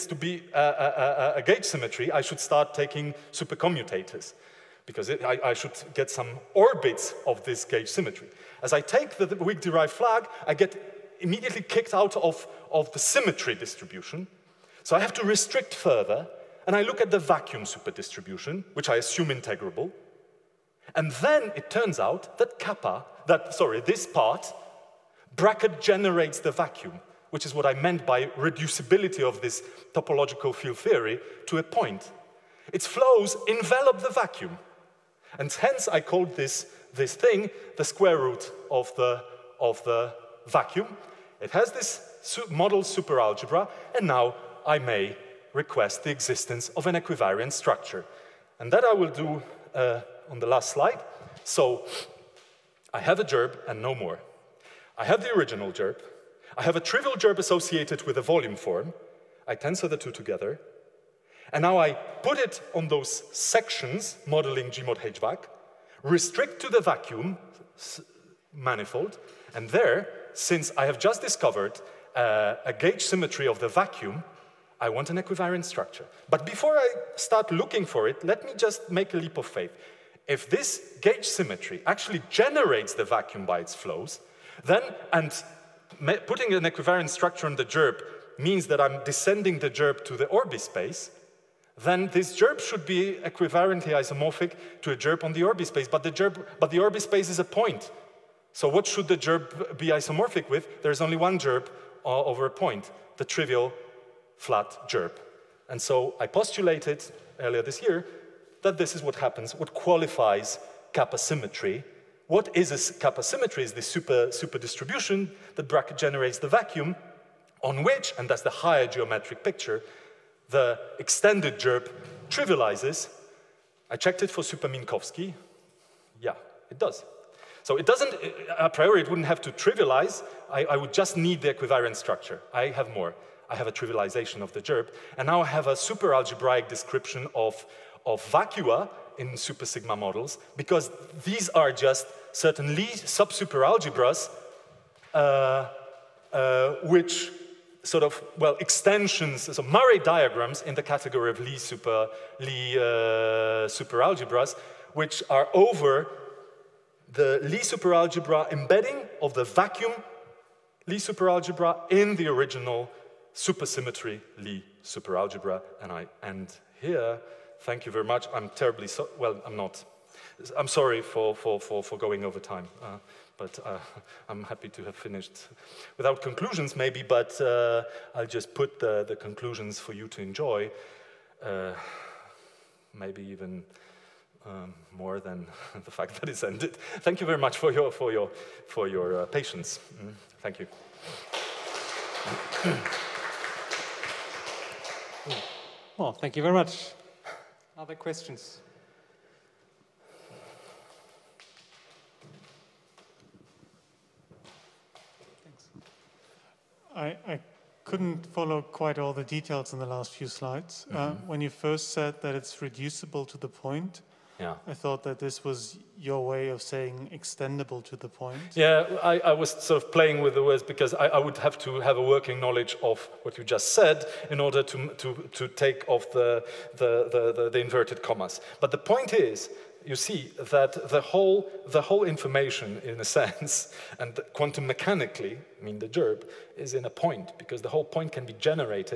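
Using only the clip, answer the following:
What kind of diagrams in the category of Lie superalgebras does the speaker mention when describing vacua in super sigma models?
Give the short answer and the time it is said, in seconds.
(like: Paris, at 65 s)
Murray diagrams, at 149 s.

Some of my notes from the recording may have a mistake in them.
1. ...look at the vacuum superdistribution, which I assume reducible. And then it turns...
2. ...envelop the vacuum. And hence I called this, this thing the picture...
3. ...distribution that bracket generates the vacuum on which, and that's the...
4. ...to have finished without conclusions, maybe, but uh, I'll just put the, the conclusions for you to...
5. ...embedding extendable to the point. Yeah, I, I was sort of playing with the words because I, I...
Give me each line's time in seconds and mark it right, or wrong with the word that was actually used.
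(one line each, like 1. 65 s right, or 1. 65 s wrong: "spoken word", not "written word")
1. 16 s wrong: "integrable", not "reducible"
2. 33 s wrong: "square", not "picture"
3. 114 s right
4. 174 s right
5. 216 s wrong: "saying", not "embedding".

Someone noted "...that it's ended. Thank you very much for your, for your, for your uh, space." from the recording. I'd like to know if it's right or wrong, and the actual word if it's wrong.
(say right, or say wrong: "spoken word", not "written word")
wrong: "patience", not "space".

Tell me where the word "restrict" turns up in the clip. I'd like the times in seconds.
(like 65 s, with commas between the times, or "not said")
15 s, 66 s.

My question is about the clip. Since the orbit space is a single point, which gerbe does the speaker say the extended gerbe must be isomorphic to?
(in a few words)
trivial flat gerbe.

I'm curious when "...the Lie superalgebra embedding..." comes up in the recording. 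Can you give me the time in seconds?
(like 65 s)
157 s.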